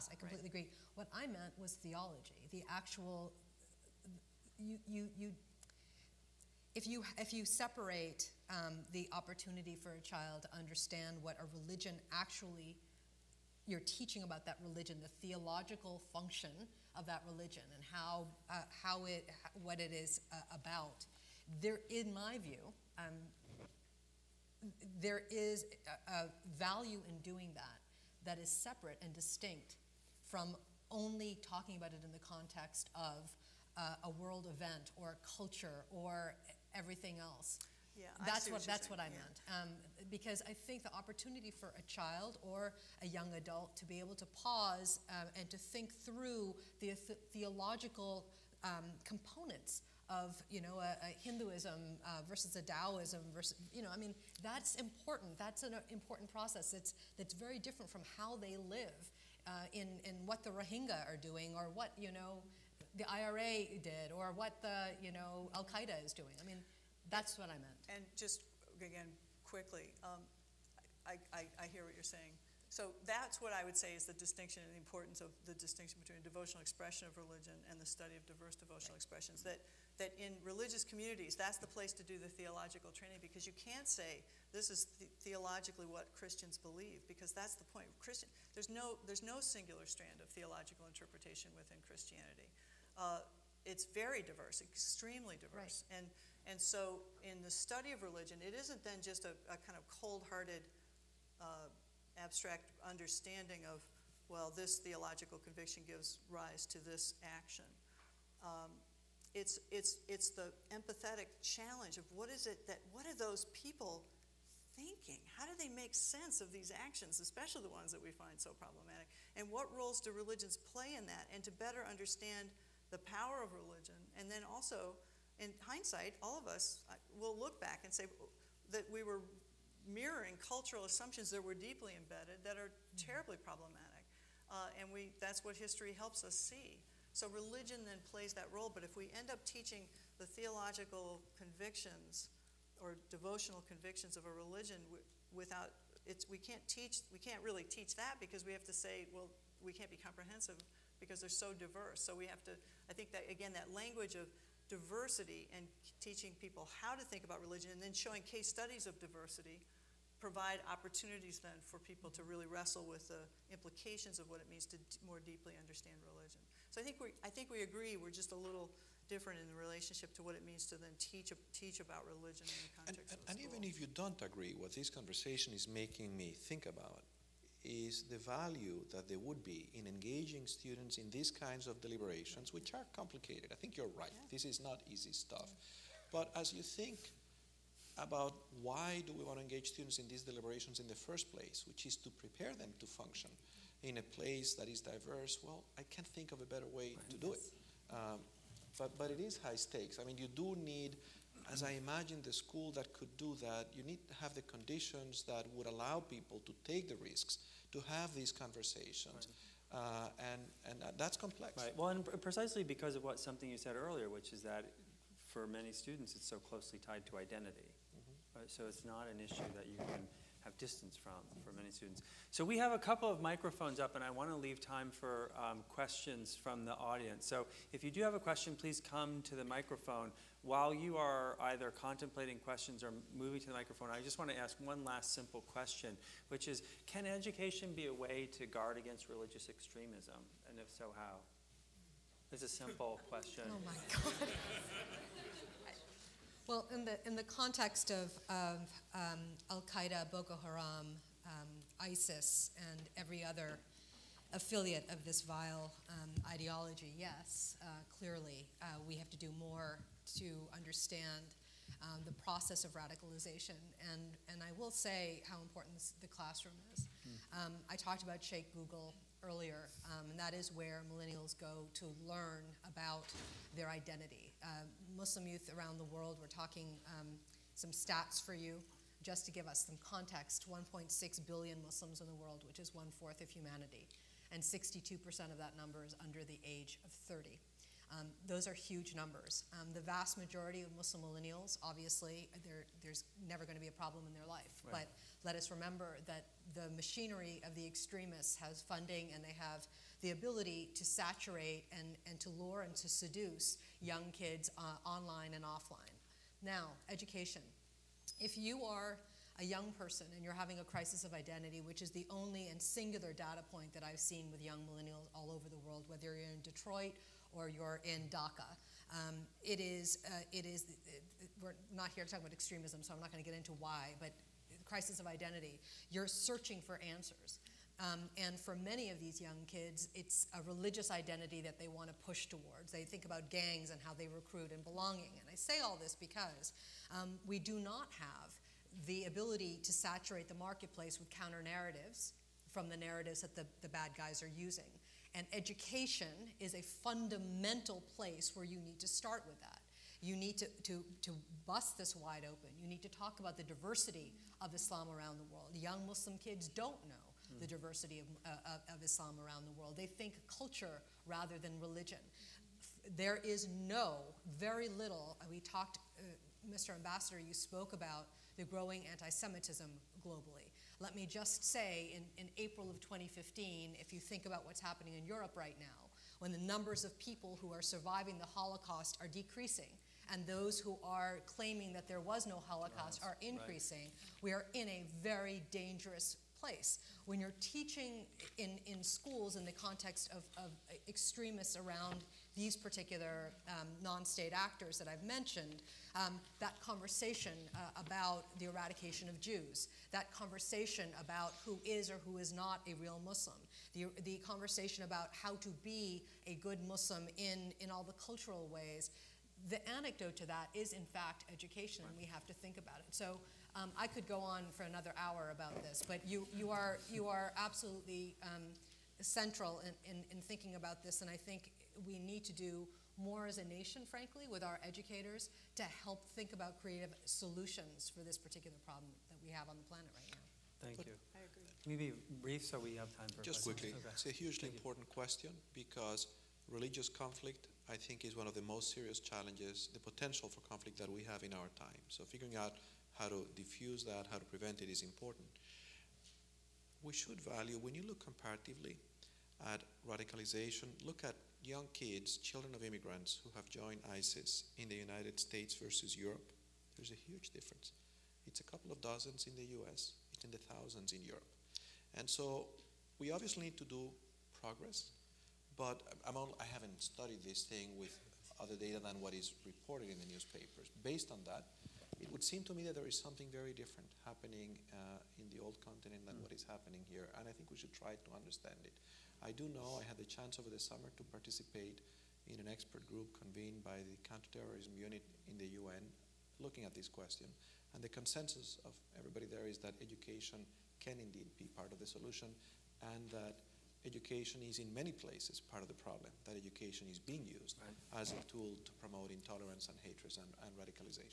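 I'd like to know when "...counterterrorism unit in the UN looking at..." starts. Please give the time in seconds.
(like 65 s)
484 s.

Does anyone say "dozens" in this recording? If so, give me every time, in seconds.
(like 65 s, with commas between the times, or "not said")
458 s.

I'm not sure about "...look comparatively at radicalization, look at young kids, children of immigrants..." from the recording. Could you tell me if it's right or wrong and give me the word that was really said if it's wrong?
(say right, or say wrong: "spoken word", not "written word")
right.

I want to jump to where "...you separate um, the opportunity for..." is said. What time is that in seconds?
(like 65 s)
7 s.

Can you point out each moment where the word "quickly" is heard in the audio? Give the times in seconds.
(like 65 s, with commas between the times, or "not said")
69 s, 433 s.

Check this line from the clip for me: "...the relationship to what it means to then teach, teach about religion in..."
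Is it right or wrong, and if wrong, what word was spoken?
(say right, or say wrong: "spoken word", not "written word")
right.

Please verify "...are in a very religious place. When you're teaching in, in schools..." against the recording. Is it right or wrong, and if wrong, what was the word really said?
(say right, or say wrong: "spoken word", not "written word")
wrong: "dangerous", not "religious".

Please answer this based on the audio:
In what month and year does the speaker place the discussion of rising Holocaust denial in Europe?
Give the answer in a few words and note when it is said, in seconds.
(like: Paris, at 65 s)
April 2015, at 372 s.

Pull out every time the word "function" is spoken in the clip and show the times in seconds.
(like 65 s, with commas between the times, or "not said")
16 s, 192 s.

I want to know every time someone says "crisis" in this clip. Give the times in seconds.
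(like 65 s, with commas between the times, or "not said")
310 s, 324 s.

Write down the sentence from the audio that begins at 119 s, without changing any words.
And what roles do religions play in that?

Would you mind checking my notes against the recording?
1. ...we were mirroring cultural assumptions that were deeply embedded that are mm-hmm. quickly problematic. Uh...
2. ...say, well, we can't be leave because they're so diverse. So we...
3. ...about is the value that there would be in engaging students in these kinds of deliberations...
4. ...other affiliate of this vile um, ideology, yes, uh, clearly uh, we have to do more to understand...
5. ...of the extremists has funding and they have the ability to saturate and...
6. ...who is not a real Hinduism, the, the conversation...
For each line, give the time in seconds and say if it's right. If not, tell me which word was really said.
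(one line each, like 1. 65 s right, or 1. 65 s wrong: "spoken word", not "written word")
1. 128 s wrong: "terribly", not "quickly"
2. 148 s wrong: "comprehensive", not "leave"
3. 176 s right
4. 253 s right
5. 297 s right
6. 402 s wrong: "Muslim", not "Hinduism".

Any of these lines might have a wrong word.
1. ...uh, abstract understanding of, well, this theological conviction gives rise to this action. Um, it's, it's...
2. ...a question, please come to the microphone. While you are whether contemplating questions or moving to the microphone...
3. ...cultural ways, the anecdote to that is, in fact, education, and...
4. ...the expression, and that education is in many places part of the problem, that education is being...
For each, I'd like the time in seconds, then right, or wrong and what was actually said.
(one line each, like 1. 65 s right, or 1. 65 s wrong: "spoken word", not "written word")
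1. 101 s right
2. 228 s wrong: "either", not "whether"
3. 408 s right
4. 491 s wrong: "solution", not "expression".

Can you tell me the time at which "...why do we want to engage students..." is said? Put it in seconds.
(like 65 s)
188 s.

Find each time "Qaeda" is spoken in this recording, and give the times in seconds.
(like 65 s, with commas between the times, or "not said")
65 s, 249 s.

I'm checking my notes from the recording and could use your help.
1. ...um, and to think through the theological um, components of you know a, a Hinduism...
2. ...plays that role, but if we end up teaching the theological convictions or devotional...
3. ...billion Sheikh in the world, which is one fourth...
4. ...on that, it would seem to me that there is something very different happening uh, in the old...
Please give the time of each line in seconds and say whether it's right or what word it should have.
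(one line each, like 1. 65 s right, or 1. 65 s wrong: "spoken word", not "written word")
1. 45 s right
2. 138 s right
3. 281 s wrong: "Muslims", not "Sheikh"
4. 471 s right.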